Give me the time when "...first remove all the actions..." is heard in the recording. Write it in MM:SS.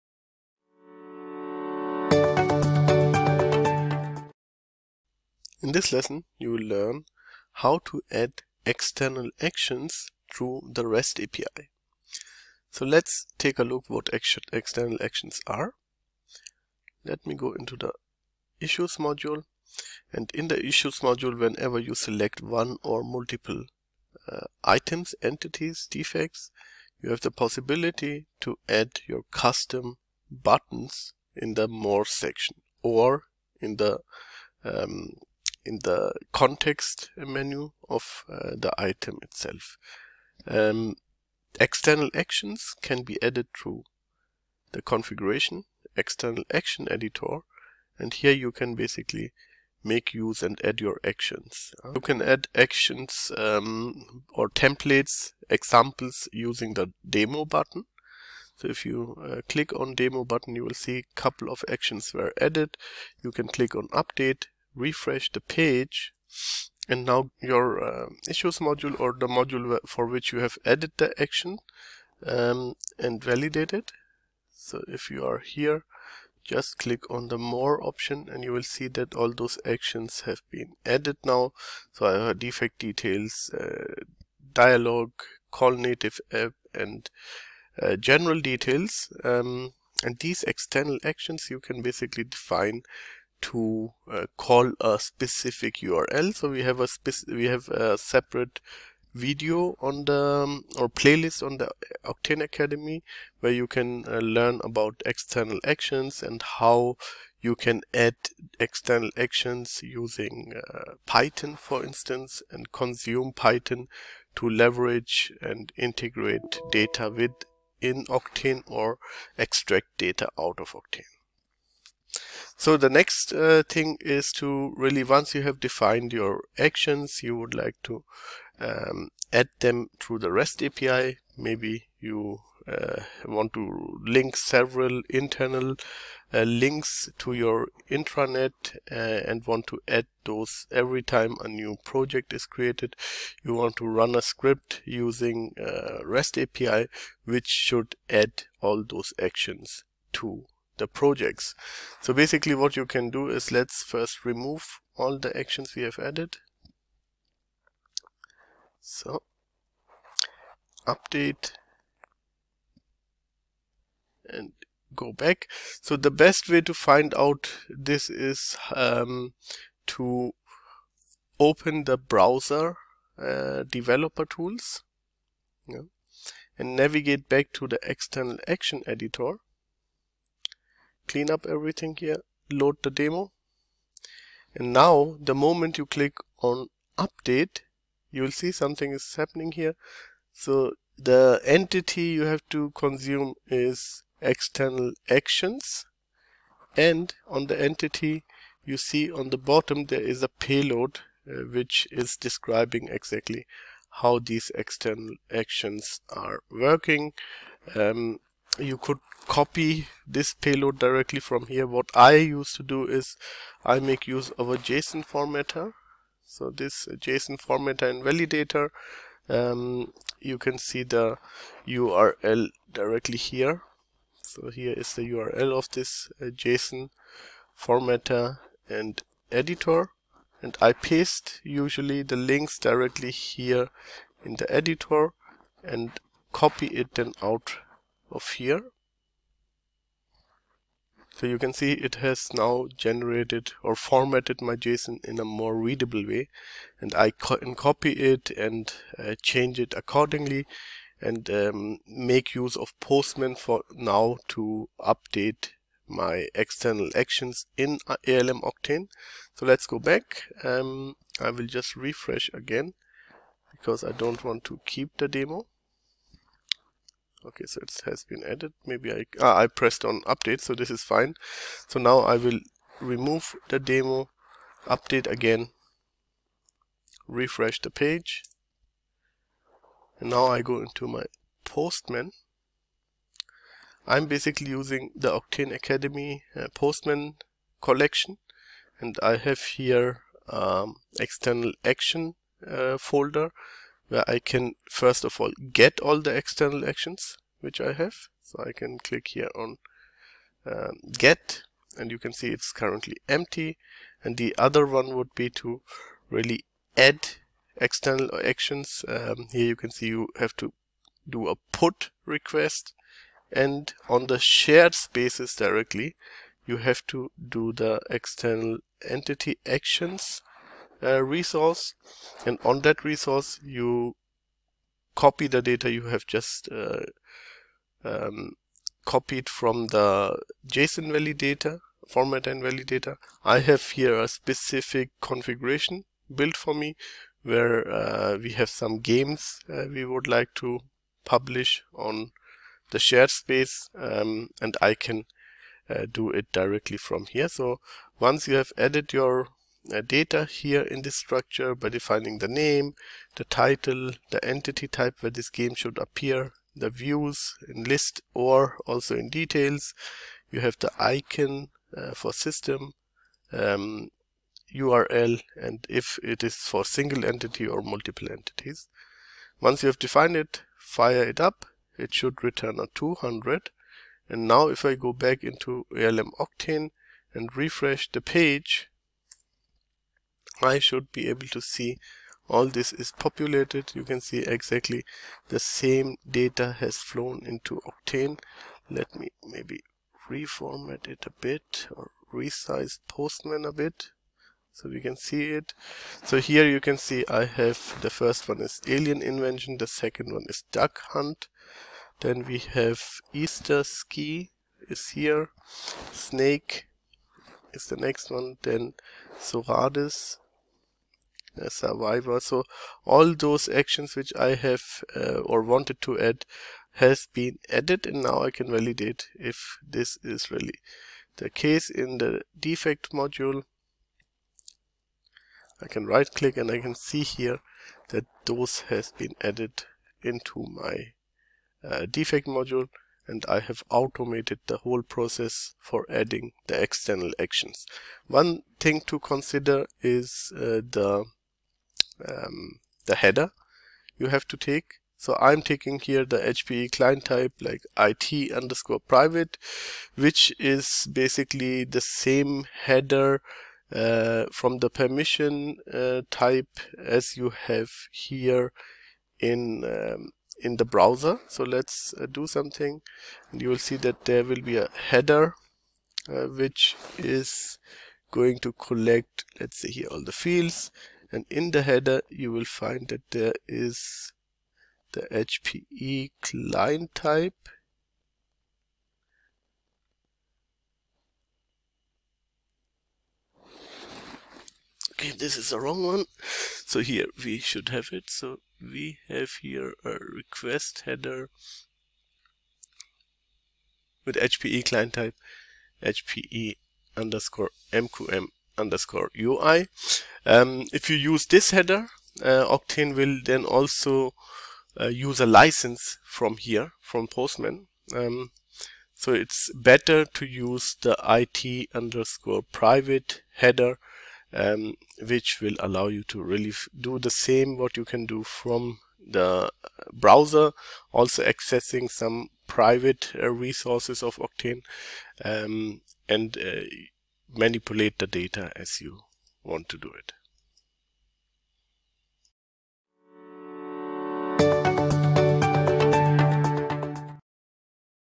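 02:33.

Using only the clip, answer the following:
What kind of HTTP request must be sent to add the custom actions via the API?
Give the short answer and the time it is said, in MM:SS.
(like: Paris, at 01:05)
put request, at 05:11.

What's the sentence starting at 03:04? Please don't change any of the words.
And now the moment you click on update, you will see something is happening here.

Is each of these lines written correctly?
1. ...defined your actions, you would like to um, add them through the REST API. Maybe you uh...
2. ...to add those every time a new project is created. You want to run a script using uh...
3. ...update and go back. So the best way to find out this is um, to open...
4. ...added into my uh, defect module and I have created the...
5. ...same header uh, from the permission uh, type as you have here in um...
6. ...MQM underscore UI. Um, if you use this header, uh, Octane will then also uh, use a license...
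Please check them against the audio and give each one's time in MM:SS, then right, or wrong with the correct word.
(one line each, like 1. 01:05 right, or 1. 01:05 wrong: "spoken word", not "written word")
1. 02:05 right
2. 02:19 right
3. 02:40 right
4. 07:09 wrong: "automated", not "created"
5. 07:31 right
6. 08:17 right.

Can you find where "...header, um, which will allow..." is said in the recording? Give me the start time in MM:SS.
08:33.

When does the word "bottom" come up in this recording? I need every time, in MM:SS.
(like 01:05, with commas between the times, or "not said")
03:19.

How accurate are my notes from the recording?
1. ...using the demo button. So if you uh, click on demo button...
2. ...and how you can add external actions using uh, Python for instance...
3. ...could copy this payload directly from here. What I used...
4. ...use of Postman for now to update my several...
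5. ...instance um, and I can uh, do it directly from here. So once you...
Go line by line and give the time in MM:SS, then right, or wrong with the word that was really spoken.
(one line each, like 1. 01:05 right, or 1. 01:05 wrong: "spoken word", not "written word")
1. 00:56 right
2. 01:46 right
3. 03:28 right
4. 04:12 wrong: "external", not "several"
5. 05:43 wrong: "space", not "instance".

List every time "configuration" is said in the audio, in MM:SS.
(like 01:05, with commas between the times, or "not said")
00:44, 05:35.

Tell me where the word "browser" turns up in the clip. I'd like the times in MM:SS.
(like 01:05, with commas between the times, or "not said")
02:51, 07:40, 08:39.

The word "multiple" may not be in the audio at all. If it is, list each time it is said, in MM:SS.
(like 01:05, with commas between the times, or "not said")
00:23, 06:07.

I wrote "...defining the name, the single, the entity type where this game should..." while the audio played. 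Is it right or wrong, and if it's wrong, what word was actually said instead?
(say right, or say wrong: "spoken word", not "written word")
wrong: "title", not "single".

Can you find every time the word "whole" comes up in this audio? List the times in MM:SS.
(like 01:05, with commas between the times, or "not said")
07:14.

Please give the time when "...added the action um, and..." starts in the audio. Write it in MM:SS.
01:10.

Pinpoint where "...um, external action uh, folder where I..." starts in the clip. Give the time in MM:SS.
04:50.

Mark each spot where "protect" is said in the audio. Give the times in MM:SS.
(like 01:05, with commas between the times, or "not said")
not said.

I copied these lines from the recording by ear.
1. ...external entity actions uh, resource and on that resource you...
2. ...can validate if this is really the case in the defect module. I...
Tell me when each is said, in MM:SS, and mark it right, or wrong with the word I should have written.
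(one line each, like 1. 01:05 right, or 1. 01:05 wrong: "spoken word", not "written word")
1. 05:17 right
2. 06:58 right.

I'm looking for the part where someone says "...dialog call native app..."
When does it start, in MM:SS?
01:24.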